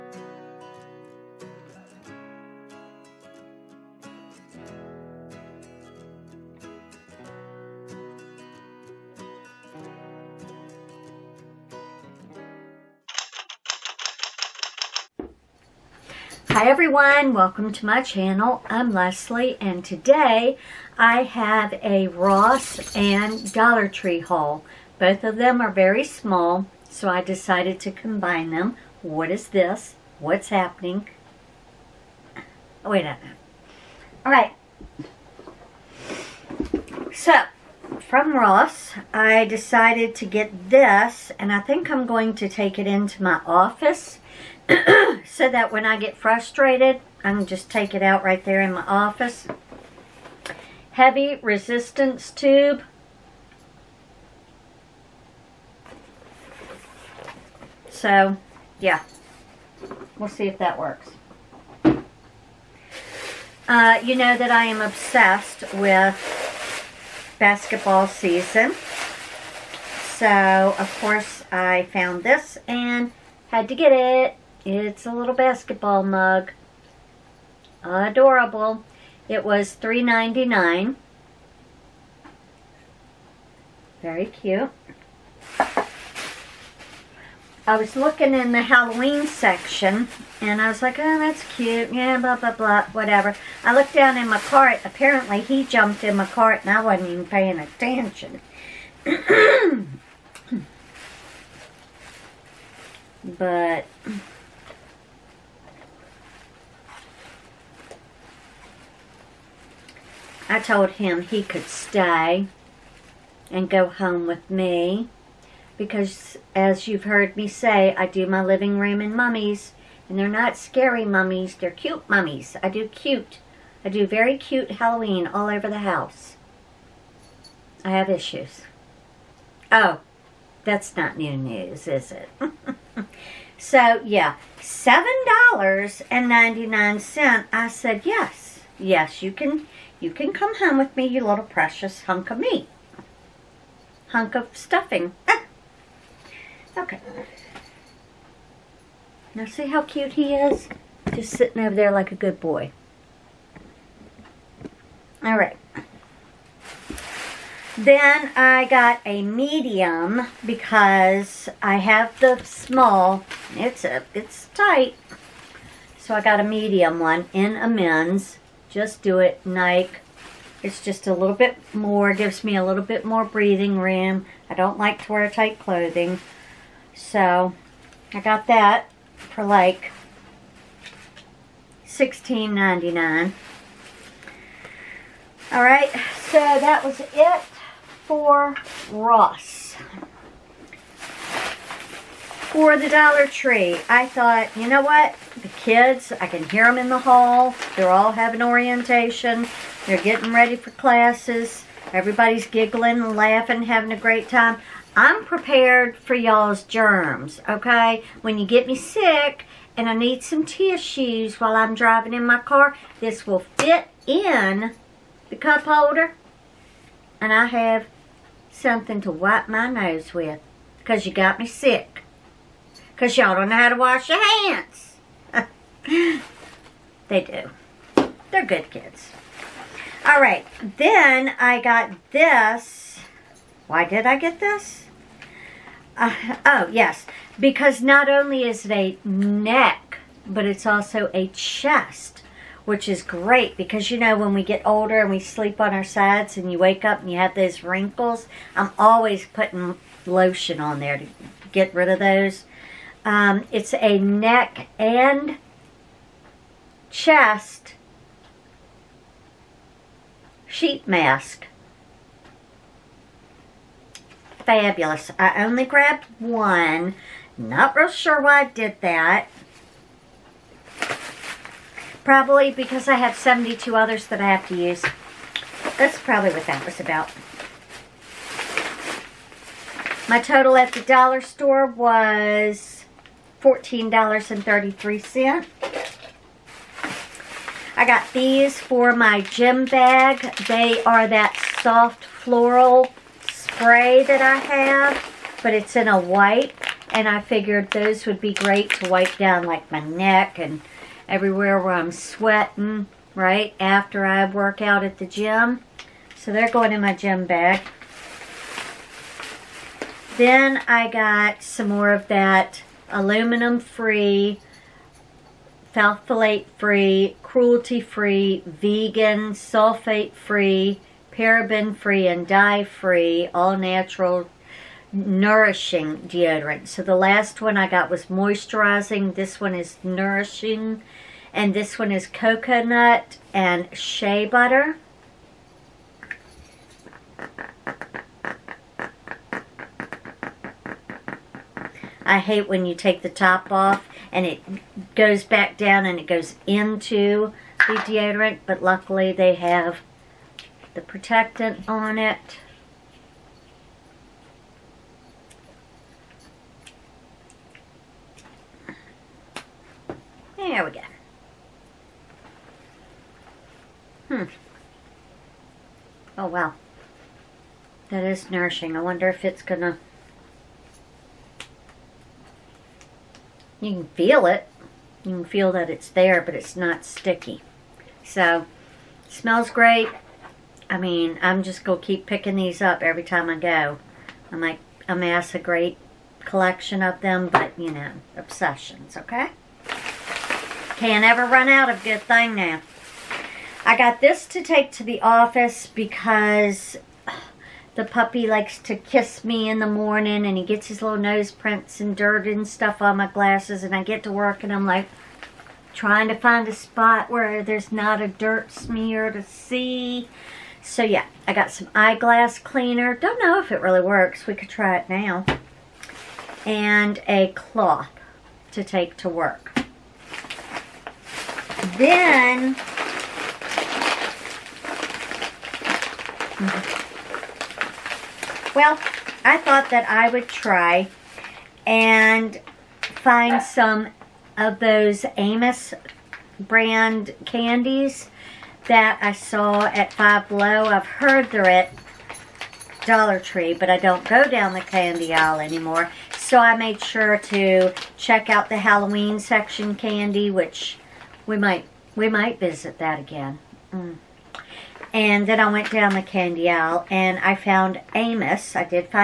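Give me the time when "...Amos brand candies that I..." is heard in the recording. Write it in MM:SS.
07:15.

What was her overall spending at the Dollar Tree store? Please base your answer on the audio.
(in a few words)
$14.33.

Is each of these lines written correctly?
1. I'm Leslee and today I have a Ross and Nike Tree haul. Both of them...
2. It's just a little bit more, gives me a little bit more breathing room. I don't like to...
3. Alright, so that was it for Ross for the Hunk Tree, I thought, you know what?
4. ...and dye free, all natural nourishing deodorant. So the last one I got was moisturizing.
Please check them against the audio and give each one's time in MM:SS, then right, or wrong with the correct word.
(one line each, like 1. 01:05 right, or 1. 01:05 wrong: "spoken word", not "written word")
1. 00:18 wrong: "Dollar", not "Nike"
2. 02:50 right
3. 03:05 wrong: "Dollar", not "Hunk"
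4. 05:22 right.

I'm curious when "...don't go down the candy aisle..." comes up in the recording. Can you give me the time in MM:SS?
07:23.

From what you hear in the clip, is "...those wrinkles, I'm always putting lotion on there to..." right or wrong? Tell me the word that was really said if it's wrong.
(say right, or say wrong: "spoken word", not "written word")
right.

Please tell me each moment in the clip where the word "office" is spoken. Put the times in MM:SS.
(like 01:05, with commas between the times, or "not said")
00:43, 00:48, 06:35.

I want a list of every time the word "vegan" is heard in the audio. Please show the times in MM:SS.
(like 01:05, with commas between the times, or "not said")
05:18.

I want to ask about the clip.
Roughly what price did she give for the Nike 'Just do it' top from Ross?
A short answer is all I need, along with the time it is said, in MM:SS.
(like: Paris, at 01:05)
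$16.99, at 03:01.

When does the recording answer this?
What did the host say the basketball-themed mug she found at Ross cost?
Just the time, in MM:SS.
01:19.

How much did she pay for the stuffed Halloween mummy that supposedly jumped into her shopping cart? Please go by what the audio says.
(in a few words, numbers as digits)
$7.99.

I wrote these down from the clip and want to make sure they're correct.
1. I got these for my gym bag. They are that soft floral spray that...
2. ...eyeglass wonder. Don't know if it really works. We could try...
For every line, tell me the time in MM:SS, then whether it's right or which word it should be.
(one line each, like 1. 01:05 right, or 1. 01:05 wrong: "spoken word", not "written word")
1. 04:47 right
2. 06:51 wrong: "cleaner", not "wonder".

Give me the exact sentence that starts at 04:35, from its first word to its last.
That's probably what that was about.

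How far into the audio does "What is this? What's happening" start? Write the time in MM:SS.
00:29.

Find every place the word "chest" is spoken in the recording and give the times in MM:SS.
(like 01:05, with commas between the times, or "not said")
04:01, 04:16.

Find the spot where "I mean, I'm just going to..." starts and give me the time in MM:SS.
06:20.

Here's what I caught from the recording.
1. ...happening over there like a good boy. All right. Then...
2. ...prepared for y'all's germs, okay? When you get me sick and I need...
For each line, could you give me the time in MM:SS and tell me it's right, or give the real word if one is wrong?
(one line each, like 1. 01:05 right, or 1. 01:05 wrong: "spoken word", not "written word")
1. 02:31 wrong: "sitting", not "happening"
2. 03:25 right.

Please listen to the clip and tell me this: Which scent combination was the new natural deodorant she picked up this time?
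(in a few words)
coconut and shea butter.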